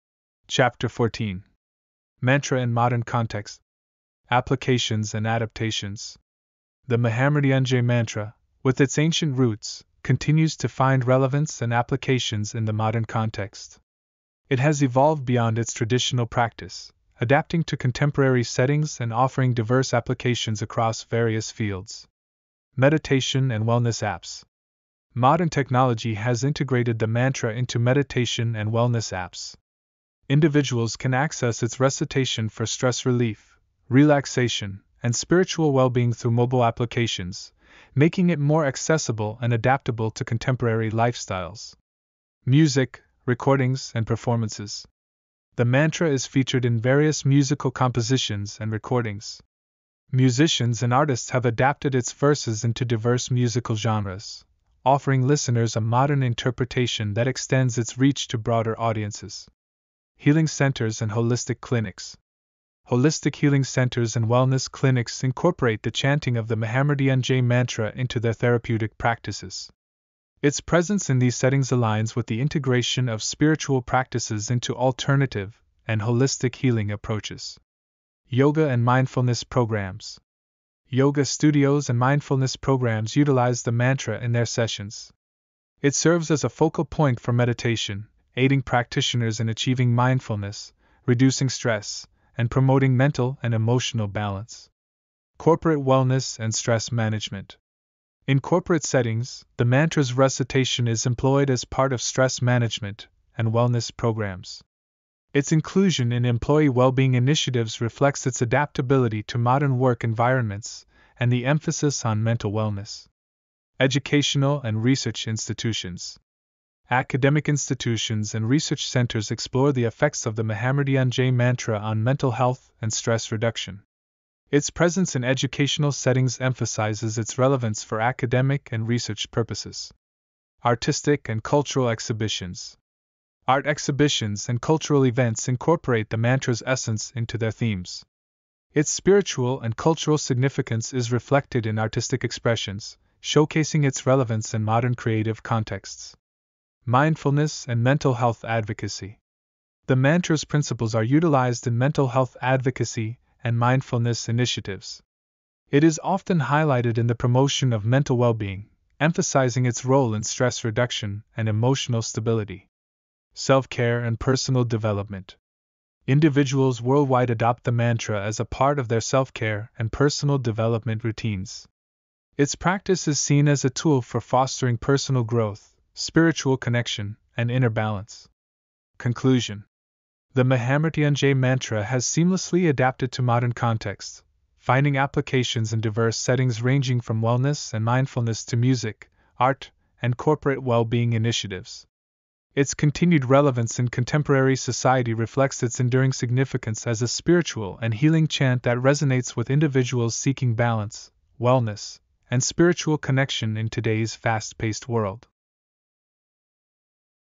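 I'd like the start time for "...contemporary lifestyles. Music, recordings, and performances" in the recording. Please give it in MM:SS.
00:40.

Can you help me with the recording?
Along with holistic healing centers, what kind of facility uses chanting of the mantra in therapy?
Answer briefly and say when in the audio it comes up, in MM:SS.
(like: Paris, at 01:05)
Holistic clinics, at 01:01.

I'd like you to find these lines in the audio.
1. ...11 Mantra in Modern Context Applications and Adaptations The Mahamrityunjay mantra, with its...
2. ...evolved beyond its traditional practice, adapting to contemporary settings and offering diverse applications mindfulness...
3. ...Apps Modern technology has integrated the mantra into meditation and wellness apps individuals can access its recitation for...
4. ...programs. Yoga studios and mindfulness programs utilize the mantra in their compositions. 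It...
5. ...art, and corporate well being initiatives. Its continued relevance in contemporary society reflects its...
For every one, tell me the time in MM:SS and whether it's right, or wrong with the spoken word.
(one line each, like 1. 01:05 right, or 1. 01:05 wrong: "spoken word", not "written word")
1. 00:00 wrong: "14", not "11"
2. 00:14 wrong: "across", not "mindfulness"
3. 00:24 right
4. 01:19 wrong: "sessions", not "compositions"
5. 03:09 right.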